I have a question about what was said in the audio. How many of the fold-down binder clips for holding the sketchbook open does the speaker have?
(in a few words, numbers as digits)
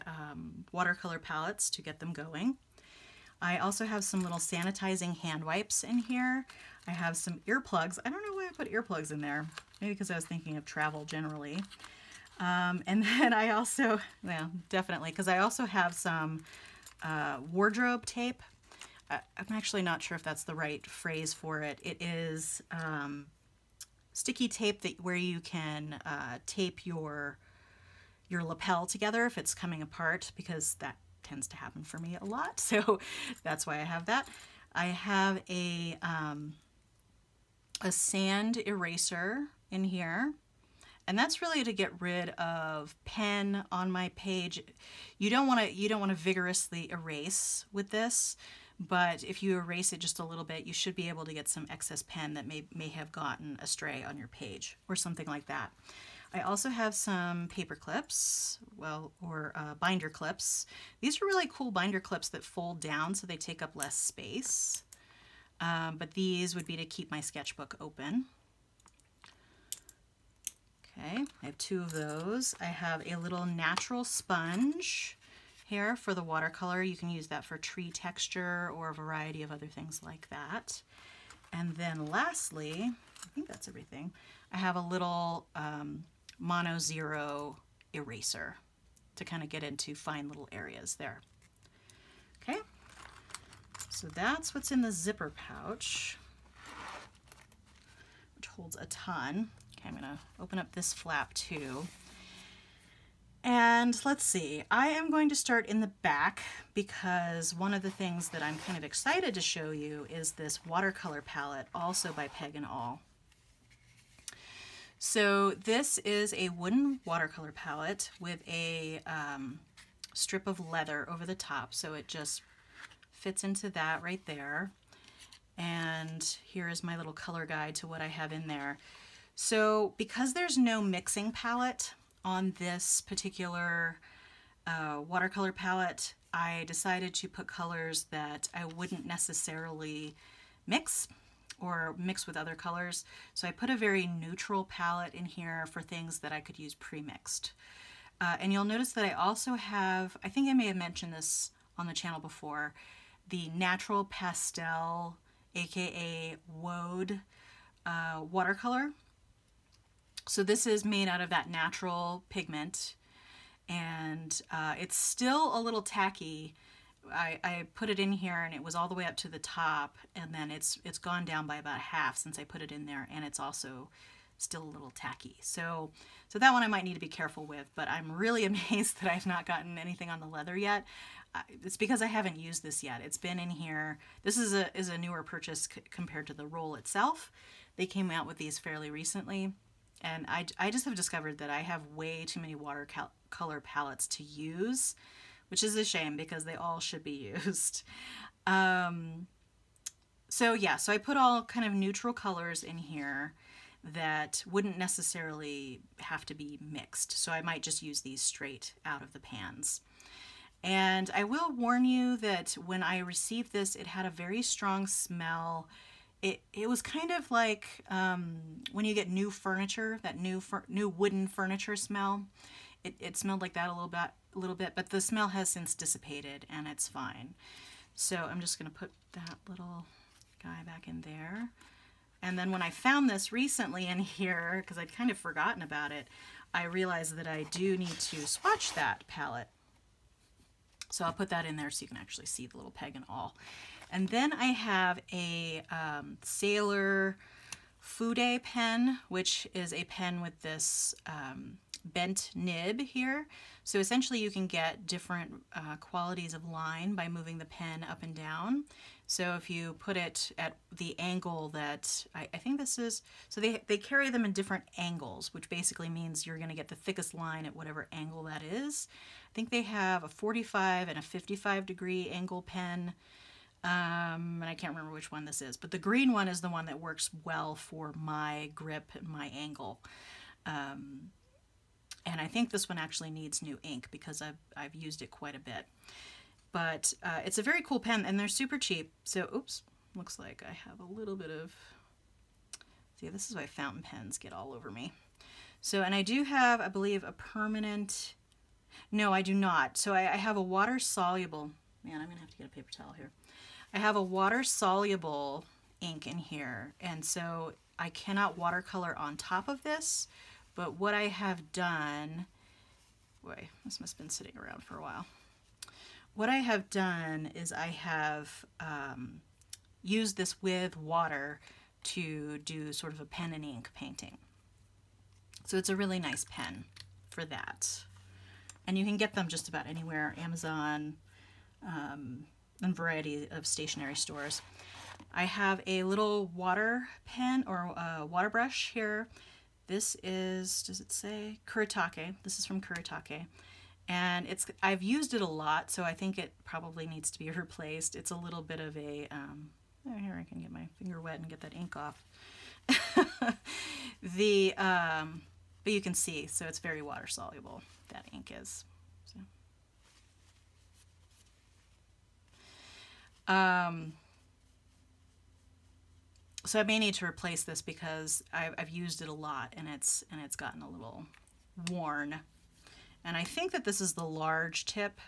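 2.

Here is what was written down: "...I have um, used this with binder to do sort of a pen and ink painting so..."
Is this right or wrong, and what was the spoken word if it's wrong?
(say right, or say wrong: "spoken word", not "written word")
wrong: "water", not "binder".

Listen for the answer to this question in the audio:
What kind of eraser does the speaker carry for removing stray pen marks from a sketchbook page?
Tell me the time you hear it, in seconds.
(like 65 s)
37 s.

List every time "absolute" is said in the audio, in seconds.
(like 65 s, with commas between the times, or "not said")
not said.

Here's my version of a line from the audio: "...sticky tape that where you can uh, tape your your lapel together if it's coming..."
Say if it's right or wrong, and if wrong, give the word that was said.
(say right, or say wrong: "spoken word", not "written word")
right.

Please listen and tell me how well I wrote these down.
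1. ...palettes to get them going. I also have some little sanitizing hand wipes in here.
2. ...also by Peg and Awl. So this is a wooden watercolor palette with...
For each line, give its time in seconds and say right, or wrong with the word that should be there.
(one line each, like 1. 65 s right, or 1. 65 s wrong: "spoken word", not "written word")
1. 1 s right
2. 111 s right.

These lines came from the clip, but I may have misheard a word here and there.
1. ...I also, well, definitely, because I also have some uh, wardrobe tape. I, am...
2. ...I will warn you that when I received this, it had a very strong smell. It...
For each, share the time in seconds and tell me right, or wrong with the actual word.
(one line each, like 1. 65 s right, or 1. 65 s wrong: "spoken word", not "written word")
1. 13 s right
2. 211 s right.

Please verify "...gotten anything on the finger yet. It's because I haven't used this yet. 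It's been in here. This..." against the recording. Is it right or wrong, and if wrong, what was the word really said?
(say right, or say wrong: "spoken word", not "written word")
wrong: "leather", not "finger".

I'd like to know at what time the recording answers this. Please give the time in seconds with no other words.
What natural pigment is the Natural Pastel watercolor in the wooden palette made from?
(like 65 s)
156 s.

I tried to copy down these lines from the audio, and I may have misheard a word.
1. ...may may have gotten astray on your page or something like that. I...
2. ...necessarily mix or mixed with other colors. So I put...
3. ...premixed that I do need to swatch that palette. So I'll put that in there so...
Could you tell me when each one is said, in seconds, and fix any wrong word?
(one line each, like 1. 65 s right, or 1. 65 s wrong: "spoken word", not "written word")
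1. 52 s right
2. 139 s right
3. 236 s wrong: "realized", not "premixed".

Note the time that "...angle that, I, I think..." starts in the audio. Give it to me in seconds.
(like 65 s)
260 s.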